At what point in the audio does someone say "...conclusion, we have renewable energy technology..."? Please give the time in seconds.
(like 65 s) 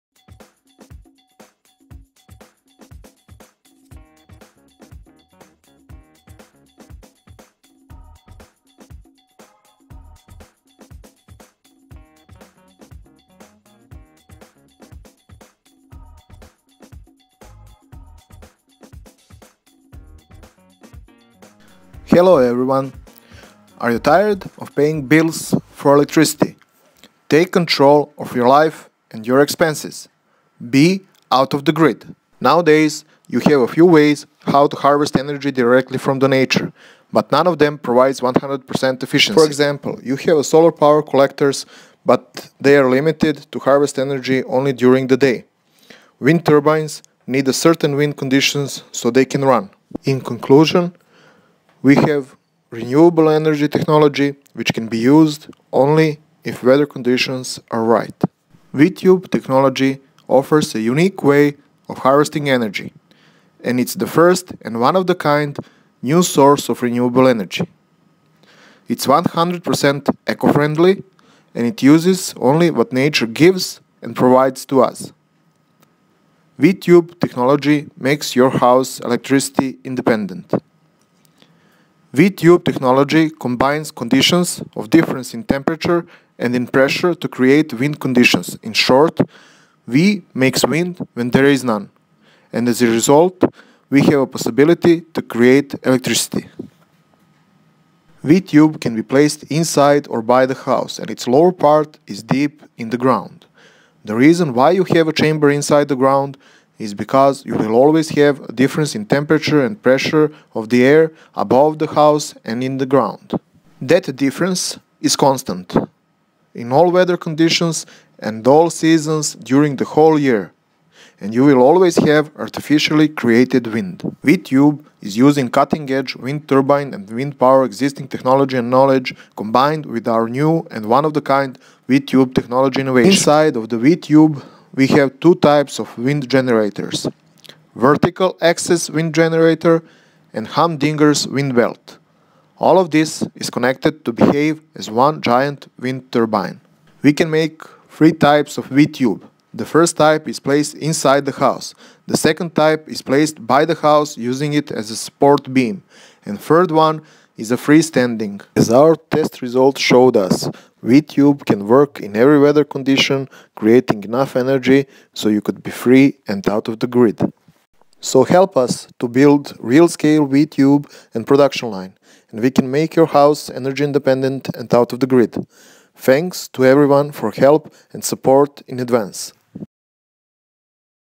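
50 s.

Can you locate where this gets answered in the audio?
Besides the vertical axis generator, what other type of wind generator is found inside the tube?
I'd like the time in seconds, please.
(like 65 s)
140 s.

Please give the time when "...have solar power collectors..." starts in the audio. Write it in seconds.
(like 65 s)
40 s.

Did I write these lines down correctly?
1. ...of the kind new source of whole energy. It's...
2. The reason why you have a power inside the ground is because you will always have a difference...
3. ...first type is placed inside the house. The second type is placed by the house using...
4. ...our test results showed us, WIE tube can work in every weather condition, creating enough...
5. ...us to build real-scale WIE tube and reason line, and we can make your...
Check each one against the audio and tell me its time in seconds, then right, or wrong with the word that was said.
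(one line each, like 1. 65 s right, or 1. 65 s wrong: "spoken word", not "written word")
1. 64 s wrong: "renewable", not "whole"
2. 104 s wrong: "chamber", not "power"
3. 149 s right
4. 158 s right
5. 168 s wrong: "production", not "reason".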